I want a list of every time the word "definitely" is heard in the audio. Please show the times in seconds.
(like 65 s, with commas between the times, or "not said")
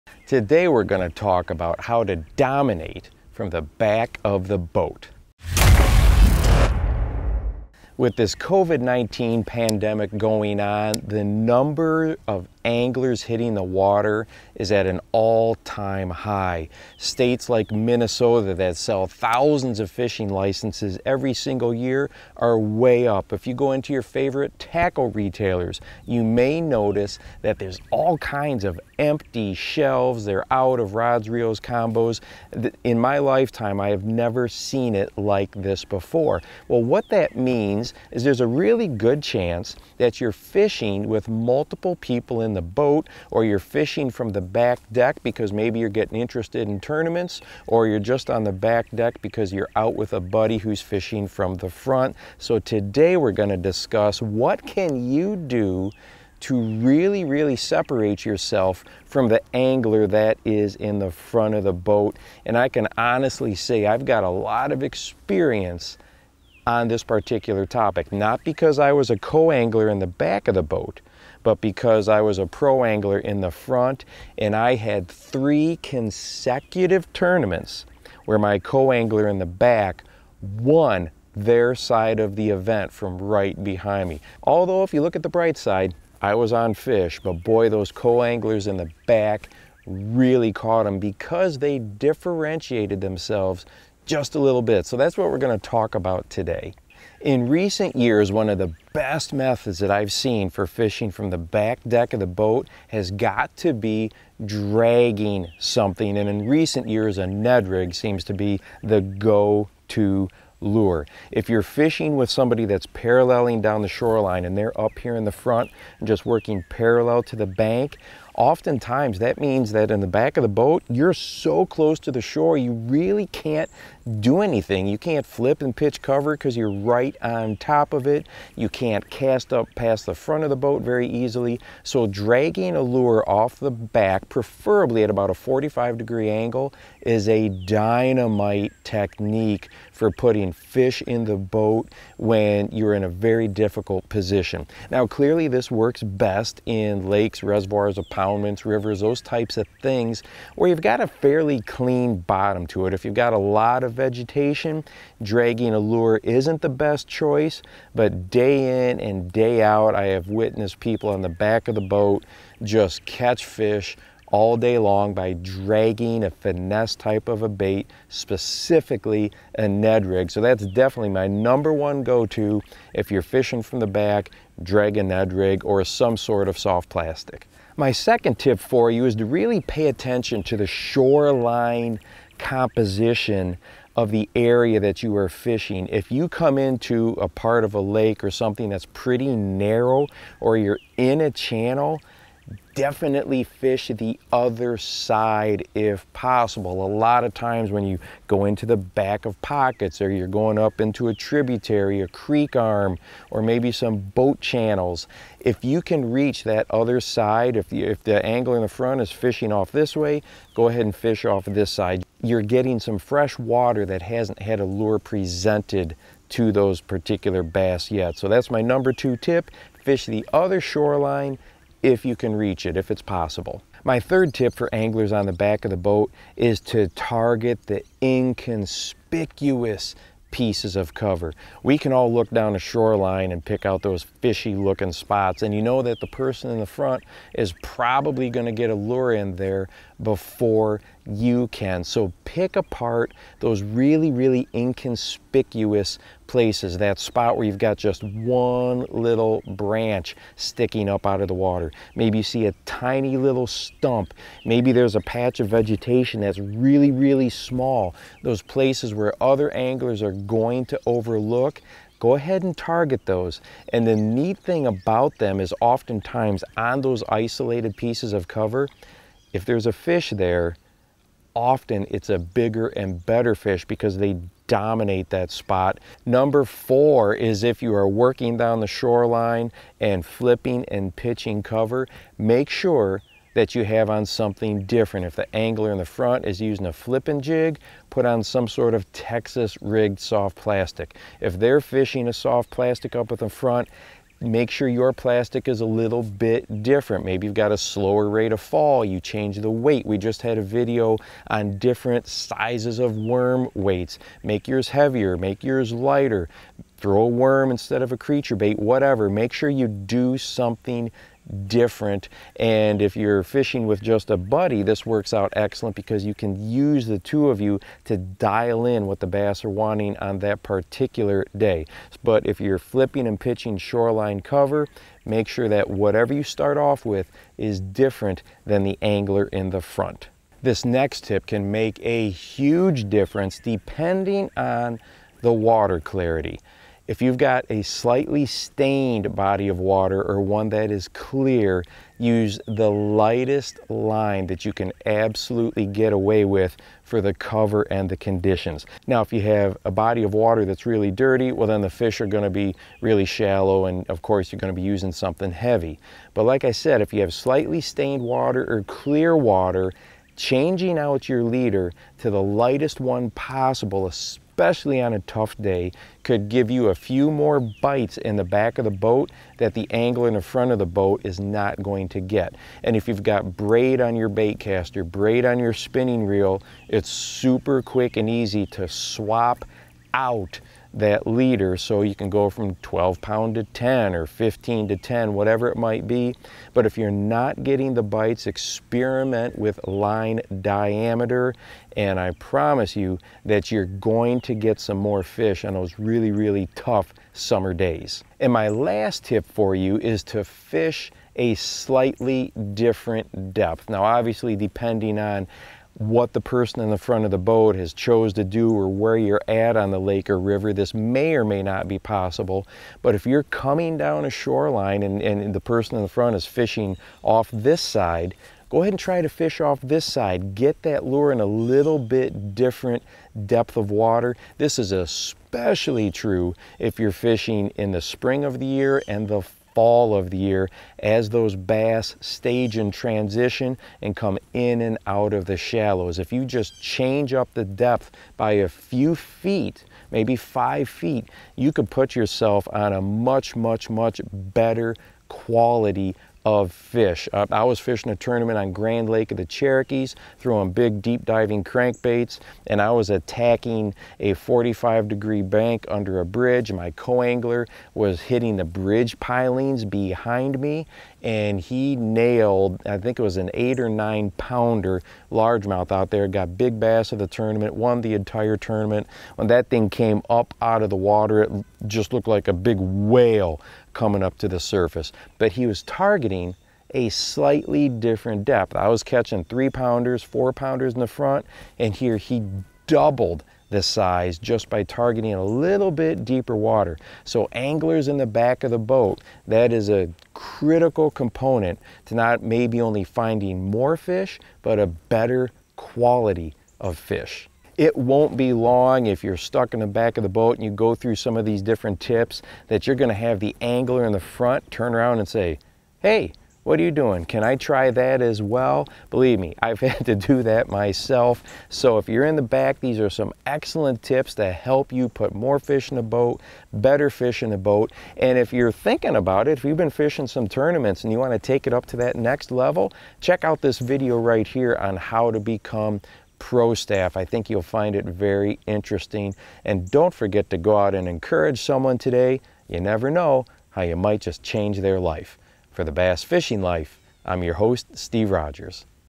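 170 s, 192 s.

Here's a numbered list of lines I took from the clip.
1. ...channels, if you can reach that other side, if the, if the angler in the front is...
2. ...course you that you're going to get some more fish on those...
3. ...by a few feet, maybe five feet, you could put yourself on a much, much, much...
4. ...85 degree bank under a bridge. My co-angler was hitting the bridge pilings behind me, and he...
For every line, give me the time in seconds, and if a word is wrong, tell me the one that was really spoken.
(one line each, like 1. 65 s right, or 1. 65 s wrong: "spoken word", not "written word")
1. 204 s right
2. 392 s wrong: "promise", not "course"
3. 438 s right
4. 454 s wrong: "45", not "85".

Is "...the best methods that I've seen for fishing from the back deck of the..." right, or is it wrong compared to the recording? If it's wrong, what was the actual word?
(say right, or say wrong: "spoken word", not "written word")
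right.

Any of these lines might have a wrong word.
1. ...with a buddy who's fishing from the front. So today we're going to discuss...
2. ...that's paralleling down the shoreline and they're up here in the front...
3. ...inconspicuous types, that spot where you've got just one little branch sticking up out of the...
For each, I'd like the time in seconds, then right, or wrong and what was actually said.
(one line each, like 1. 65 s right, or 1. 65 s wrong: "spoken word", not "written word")
1. 49 s right
2. 112 s right
3. 244 s wrong: "places", not "types".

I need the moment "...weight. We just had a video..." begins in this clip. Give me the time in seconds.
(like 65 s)
299 s.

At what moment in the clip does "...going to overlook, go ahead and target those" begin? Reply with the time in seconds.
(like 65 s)
260 s.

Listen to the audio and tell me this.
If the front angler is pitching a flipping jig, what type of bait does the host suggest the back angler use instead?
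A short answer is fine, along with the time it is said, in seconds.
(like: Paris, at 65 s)
Texas rigged soft plastic, at 288 s.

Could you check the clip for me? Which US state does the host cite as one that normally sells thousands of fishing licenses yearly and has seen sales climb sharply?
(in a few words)
Minnesota.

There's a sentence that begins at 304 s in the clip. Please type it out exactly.
Make yours heavier, make yours lighter, throw a worm instead of a creature bait, whatever.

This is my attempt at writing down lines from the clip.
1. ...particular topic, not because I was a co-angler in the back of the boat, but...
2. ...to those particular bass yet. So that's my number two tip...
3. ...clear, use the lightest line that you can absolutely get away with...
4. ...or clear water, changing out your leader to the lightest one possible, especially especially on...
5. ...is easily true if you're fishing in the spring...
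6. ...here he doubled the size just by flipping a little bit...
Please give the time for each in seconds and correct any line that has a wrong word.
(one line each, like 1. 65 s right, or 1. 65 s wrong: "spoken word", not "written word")
1. 67 s right
2. 216 s right
3. 340 s right
4. 358 s right
5. 424 s wrong: "especially", not "easily"
6. 481 s wrong: "targeting", not "flipping".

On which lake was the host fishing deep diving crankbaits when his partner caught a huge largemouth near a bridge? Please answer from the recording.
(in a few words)
Grand Lake of the Cherokees.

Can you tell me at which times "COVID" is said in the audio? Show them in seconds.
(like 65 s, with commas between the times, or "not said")
8 s.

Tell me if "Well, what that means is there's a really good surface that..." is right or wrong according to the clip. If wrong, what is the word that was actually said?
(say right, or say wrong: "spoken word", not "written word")
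wrong: "chance", not "surface".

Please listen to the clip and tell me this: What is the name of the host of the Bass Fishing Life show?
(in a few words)
Steve Rogers.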